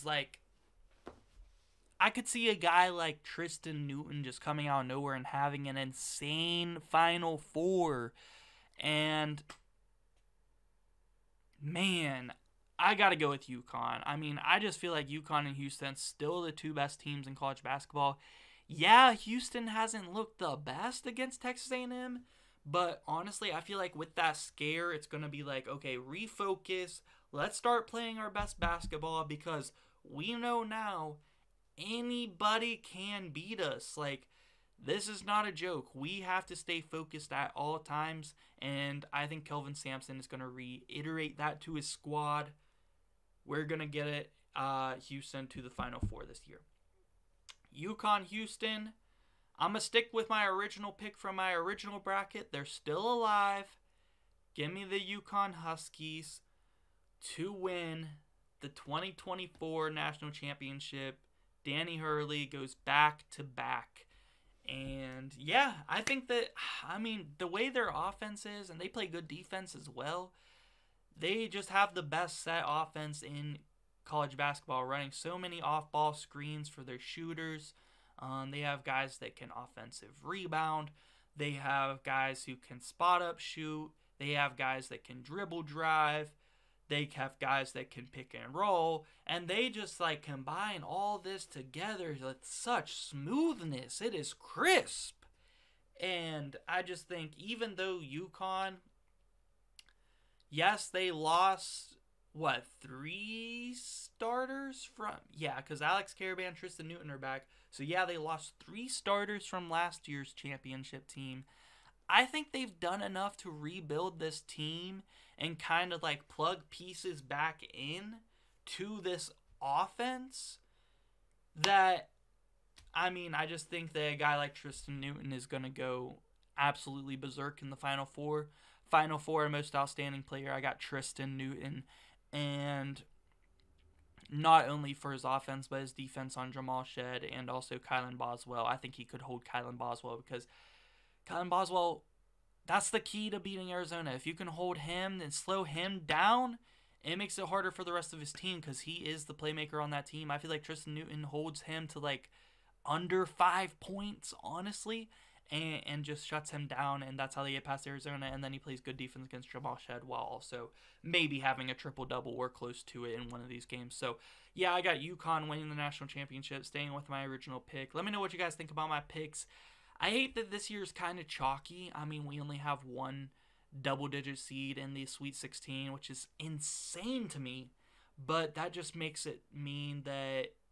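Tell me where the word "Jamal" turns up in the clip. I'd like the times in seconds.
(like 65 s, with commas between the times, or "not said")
136 s, 159 s.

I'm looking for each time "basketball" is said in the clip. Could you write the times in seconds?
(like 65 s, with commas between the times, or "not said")
17 s, 28 s, 74 s.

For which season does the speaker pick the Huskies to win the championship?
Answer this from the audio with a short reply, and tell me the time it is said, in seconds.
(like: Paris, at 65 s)
2024, at 58 s.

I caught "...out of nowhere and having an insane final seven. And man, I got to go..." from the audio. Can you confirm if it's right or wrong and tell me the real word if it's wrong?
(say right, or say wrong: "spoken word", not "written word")
wrong: "four", not "seven".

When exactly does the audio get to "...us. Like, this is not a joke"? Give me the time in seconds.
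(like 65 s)
33 s.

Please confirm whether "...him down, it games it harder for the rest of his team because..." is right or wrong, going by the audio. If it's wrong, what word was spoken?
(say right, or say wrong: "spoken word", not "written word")
wrong: "makes", not "games".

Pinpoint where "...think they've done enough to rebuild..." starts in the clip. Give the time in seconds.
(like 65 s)
112 s.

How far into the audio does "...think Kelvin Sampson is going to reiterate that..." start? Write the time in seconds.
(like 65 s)
39 s.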